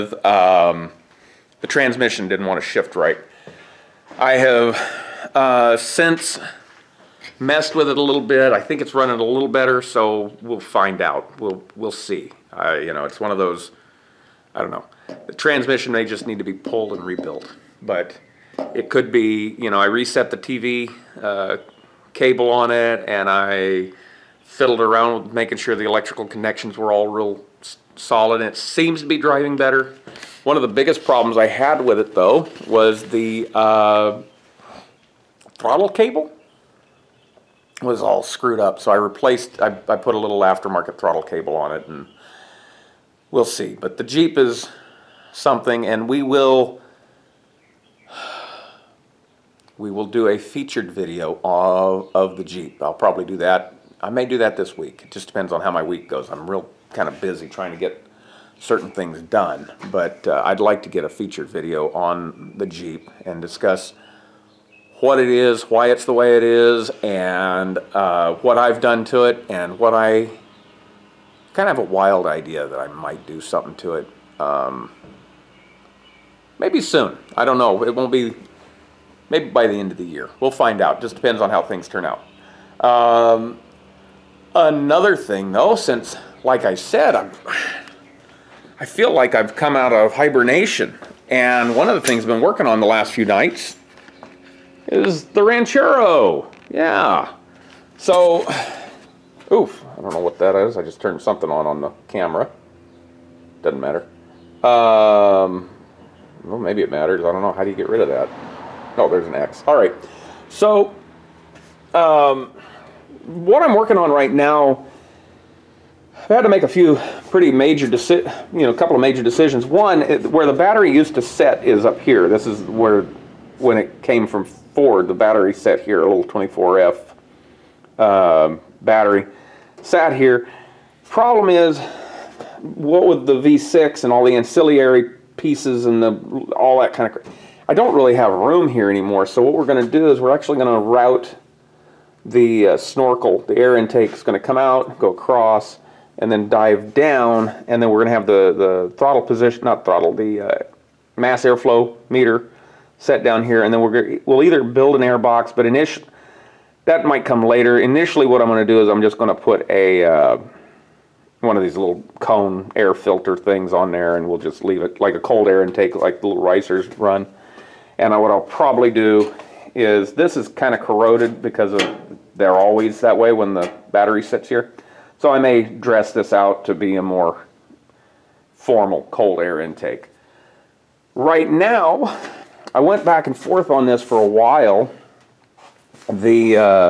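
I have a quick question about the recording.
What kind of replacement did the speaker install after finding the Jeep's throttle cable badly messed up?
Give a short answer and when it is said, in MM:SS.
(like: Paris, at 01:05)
aftermarket throttle cable, at 00:40.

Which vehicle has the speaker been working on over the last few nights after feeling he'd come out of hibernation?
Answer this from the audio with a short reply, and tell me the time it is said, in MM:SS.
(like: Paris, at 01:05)
Ranchero, at 01:35.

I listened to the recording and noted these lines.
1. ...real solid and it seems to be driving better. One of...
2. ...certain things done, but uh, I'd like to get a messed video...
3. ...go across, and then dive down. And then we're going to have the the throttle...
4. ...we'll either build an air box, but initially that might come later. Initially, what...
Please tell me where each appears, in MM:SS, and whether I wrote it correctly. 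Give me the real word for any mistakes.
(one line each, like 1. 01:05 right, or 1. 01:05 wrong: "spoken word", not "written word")
1. 00:27 right
2. 00:58 wrong: "featured", not "messed"
3. 02:24 right
4. 02:34 right.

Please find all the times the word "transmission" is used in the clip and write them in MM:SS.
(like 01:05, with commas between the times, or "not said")
00:01, 00:15.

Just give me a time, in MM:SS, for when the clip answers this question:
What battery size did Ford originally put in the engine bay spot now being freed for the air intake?
02:06.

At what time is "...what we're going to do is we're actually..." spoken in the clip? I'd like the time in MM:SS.
02:19.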